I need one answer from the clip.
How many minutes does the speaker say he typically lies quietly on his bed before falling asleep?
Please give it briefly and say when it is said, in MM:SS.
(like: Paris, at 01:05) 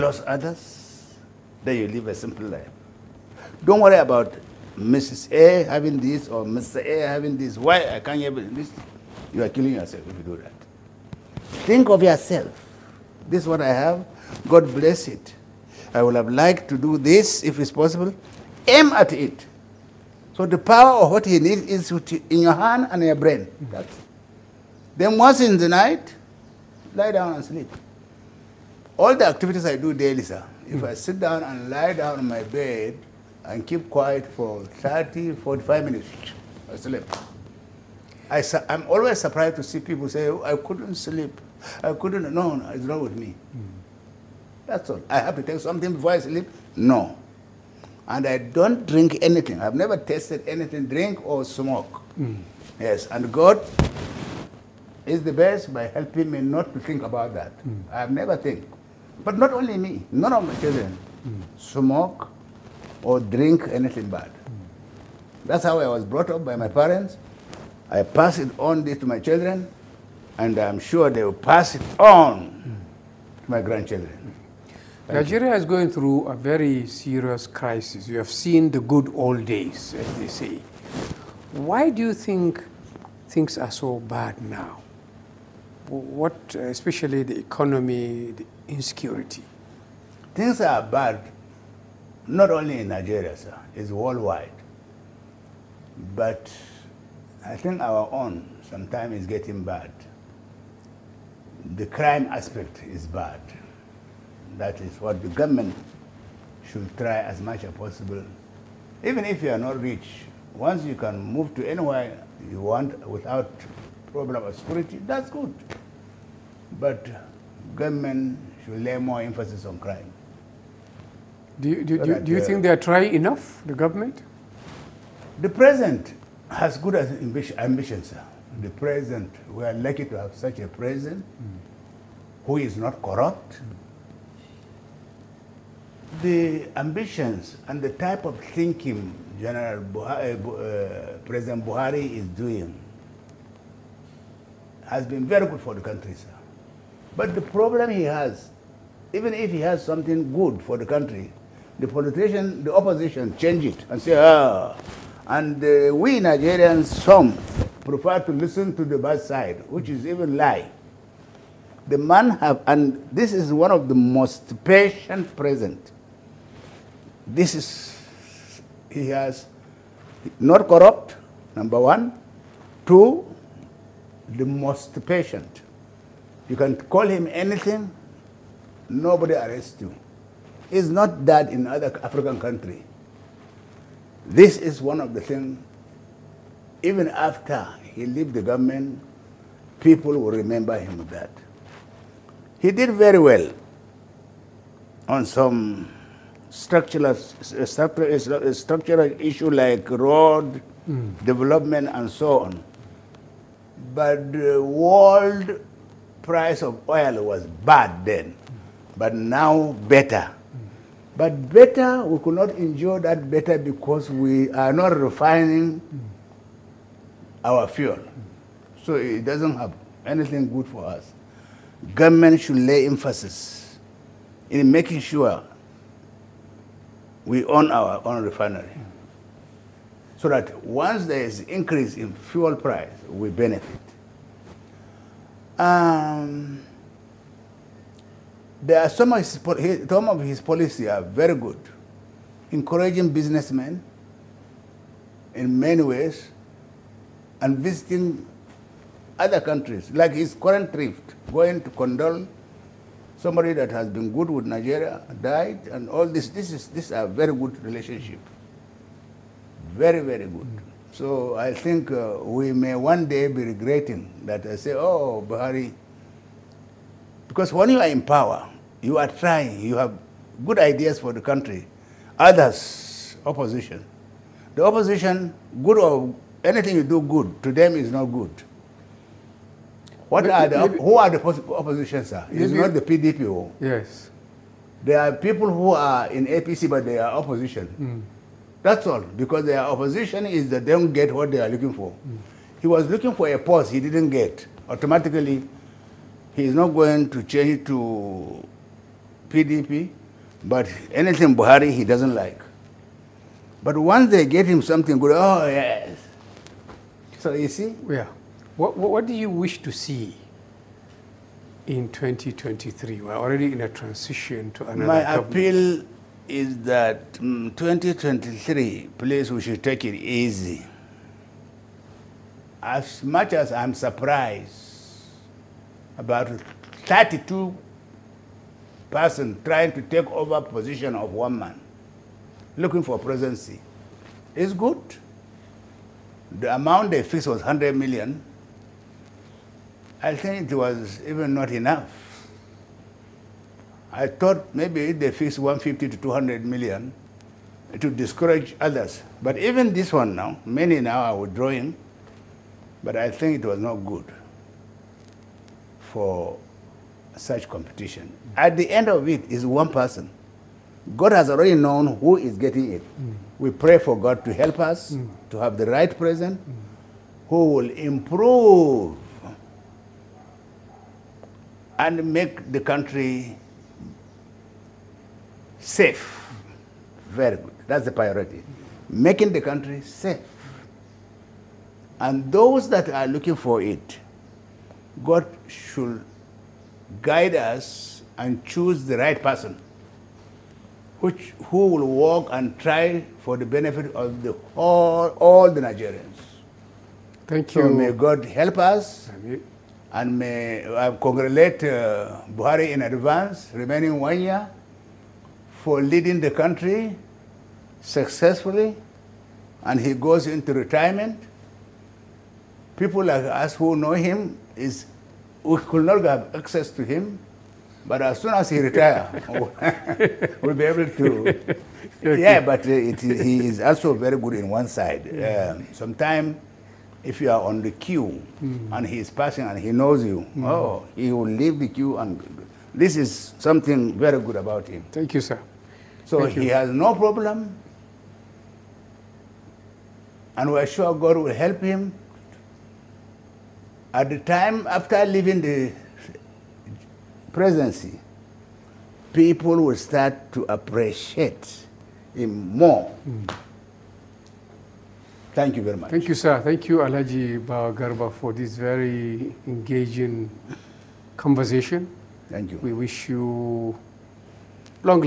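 30, 45 minutes, at 00:34.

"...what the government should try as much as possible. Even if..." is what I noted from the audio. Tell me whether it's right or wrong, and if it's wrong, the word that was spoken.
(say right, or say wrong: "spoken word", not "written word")
right.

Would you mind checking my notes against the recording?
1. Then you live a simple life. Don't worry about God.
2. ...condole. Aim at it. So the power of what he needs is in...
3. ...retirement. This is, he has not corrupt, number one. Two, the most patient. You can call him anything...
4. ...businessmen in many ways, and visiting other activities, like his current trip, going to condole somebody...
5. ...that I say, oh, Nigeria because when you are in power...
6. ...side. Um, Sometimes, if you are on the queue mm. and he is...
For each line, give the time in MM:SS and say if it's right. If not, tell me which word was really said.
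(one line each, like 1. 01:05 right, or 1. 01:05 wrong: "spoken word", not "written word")
1. 00:01 wrong: "Mrs", not "God"
2. 00:17 wrong: "possible", not "condole"
3. 02:45 wrong: "present", not "retirement"
4. 04:03 wrong: "countries", not "activities"
5. 04:24 wrong: "Buhari", not "Nigeria"
6. 07:04 right.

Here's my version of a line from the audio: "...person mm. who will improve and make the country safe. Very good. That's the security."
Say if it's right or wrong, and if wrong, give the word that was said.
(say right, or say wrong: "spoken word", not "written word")
wrong: "priority", not "security".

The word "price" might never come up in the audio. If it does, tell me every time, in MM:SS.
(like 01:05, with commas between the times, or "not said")
03:26, 03:52.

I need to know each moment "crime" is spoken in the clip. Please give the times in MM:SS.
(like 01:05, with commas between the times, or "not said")
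01:41, 01:59.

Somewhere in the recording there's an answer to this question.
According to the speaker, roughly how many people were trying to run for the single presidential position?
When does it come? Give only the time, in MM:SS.
05:26.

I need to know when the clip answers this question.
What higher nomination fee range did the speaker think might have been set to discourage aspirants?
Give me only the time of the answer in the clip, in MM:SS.
05:45.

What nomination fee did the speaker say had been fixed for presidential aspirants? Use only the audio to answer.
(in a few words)
100 million.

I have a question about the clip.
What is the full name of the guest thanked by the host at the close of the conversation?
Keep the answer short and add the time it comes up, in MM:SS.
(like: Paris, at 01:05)
Alhaji Bawa Garba, at 07:36.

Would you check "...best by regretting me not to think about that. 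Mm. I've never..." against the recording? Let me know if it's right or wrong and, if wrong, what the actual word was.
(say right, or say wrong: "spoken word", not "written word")
wrong: "helping", not "regretting".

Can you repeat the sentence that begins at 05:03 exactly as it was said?
But once they get him something good, oh yes.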